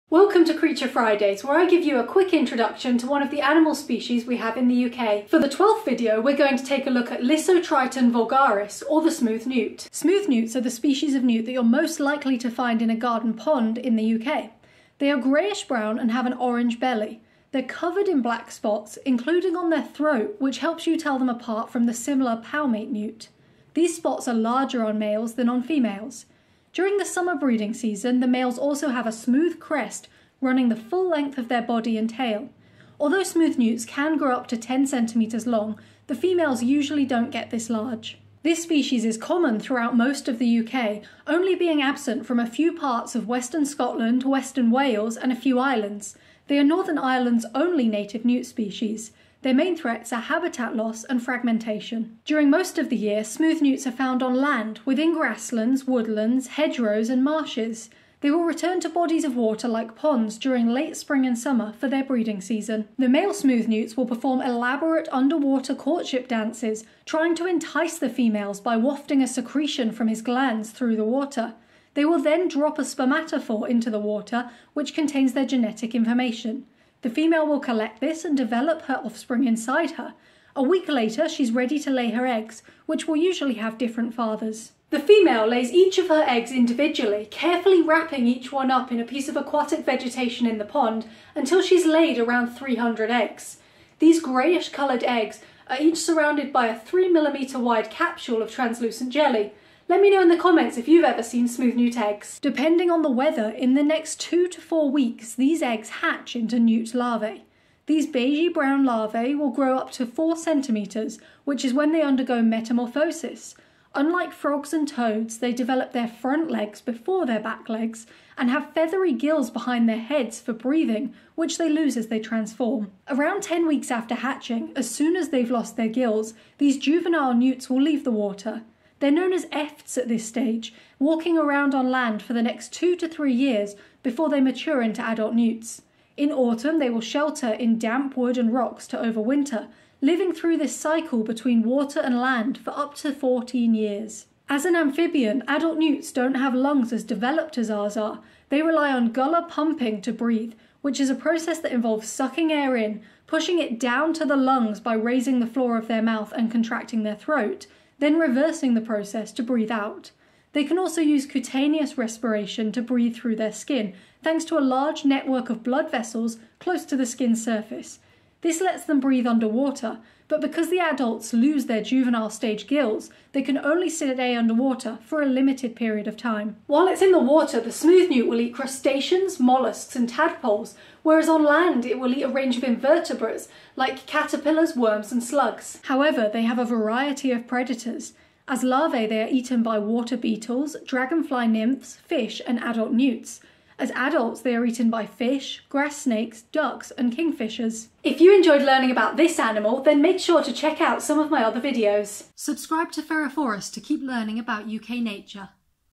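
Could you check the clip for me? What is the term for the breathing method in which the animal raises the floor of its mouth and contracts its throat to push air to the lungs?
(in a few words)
Gular pumping.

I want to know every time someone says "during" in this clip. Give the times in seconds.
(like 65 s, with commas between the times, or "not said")
26 s, 52 s, 60 s.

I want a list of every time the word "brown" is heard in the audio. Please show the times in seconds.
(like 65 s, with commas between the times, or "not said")
15 s, 108 s.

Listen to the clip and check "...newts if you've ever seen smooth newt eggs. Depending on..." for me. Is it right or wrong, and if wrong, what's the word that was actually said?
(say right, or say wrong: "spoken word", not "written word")
wrong: "comments", not "newts".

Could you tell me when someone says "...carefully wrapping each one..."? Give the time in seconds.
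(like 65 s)
87 s.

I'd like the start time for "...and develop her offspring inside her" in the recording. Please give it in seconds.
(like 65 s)
78 s.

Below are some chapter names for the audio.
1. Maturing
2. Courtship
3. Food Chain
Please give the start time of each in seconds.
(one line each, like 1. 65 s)
1. 102 s
2. 63 s
3. 176 s.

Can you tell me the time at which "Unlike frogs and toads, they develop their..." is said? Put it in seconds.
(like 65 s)
113 s.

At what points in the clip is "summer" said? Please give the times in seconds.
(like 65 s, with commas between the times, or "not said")
27 s, 61 s.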